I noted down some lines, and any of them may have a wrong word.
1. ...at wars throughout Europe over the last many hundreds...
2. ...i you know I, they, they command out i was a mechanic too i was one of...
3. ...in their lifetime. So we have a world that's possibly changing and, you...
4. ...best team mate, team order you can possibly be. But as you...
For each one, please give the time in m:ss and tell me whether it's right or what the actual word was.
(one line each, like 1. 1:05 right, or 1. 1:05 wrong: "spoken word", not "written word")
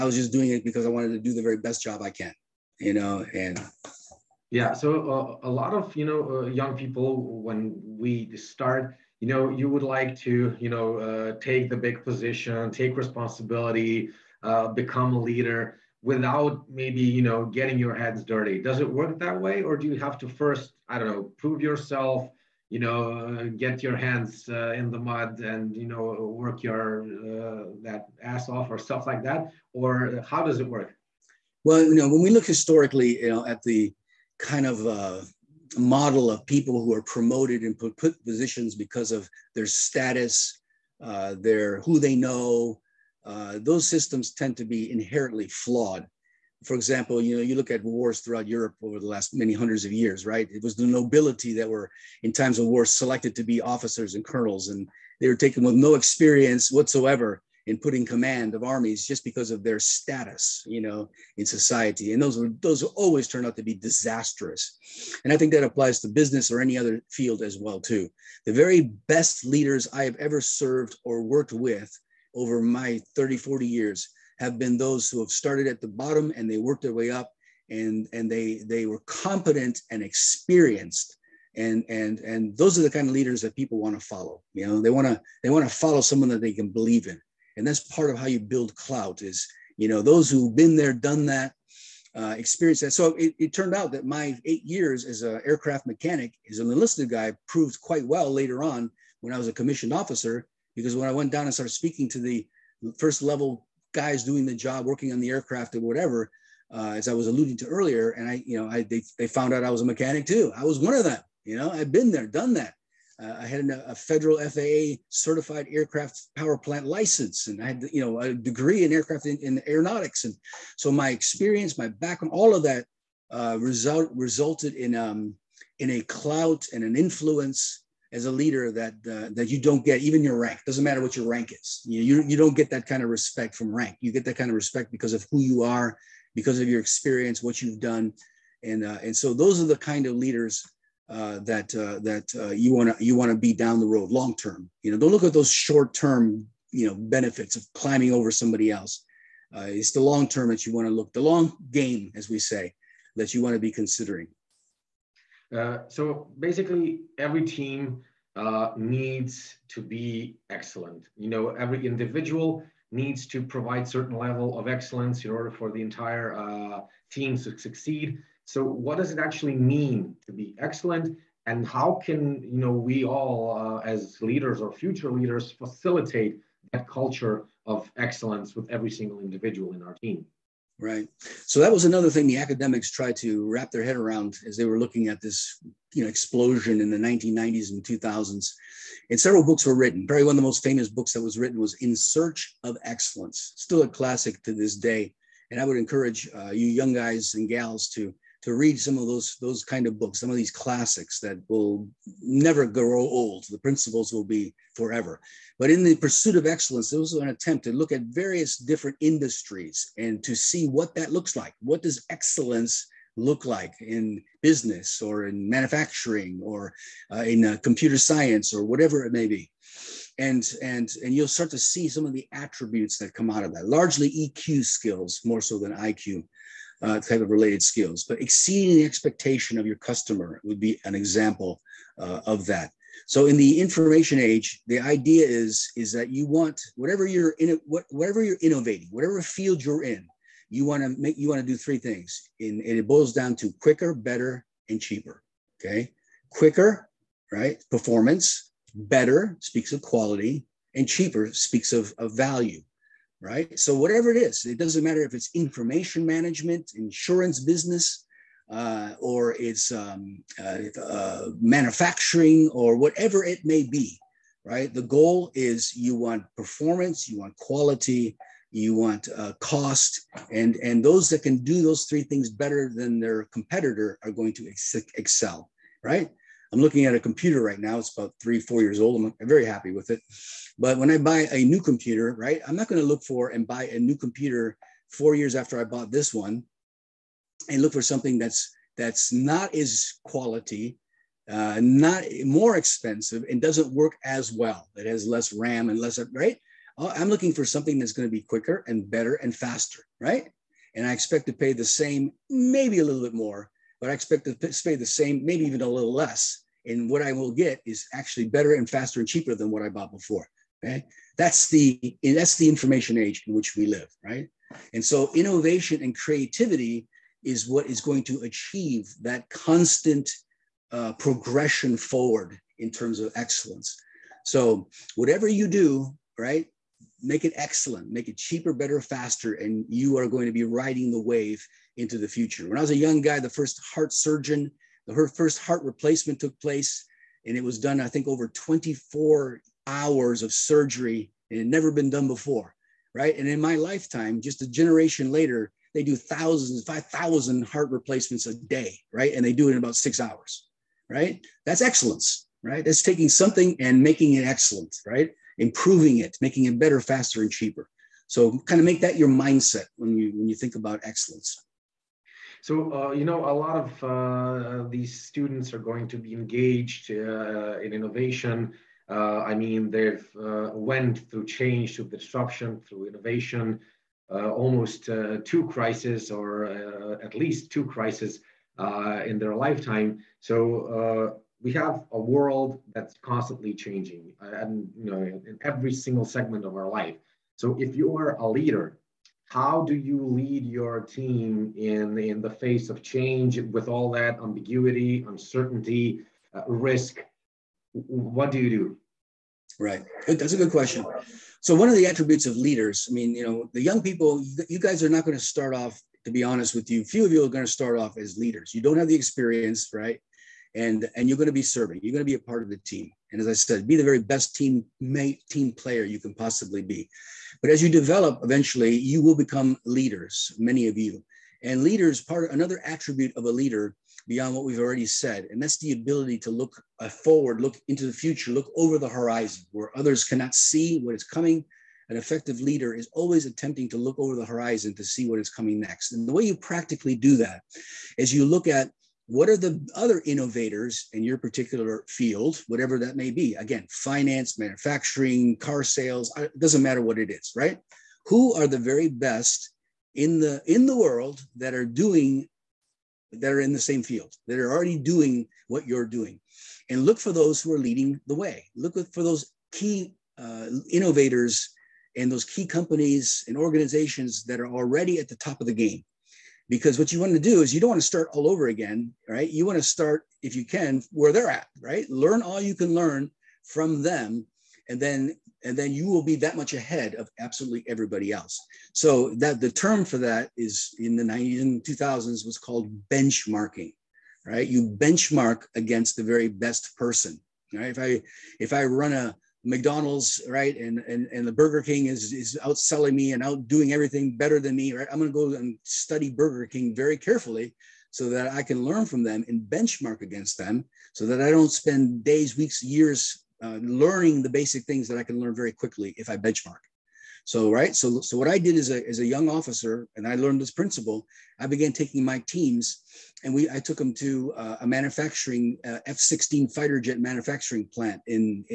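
1. 0:47 right
2. 1:48 wrong: "found", not "command"
3. 6:19 wrong: "constantly", not "possibly"
4. 6:54 wrong: "player", not "order".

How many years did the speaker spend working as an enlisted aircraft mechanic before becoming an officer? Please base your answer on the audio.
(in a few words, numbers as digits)
8.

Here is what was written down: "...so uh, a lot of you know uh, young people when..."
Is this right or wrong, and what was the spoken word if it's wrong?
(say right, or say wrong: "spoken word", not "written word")
right.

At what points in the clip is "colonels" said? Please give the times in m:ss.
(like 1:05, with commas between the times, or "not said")
0:54.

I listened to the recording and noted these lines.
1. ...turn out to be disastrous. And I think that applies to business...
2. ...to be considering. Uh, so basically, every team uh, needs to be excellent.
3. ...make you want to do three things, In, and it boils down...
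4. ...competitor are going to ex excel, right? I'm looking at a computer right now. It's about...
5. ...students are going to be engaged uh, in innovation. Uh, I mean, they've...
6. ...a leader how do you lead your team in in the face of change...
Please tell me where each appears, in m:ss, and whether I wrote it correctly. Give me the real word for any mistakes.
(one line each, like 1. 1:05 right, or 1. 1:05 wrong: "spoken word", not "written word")
1. 1:03 right
2. 2:33 right
3. 4:01 right
4. 4:33 right
5. 6:05 right
6. 6:28 right.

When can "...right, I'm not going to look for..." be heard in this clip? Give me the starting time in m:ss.
4:42.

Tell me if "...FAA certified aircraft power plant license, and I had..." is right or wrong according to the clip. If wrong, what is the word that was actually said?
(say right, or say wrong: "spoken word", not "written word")
right.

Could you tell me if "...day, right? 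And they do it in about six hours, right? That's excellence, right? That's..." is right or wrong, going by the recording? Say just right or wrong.
right.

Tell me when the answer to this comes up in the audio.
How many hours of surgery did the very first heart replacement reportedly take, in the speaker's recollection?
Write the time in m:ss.
5:38.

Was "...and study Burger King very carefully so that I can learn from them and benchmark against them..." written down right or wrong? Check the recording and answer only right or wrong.
right.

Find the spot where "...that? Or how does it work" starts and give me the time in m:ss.
0:29.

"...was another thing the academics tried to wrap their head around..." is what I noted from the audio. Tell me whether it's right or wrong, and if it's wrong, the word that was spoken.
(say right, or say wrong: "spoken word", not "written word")
right.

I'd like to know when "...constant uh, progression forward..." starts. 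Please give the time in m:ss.
5:19.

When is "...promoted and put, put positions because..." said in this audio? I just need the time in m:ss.
0:37.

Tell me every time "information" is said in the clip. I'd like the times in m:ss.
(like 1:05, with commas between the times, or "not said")
3:53, 4:15, 5:12.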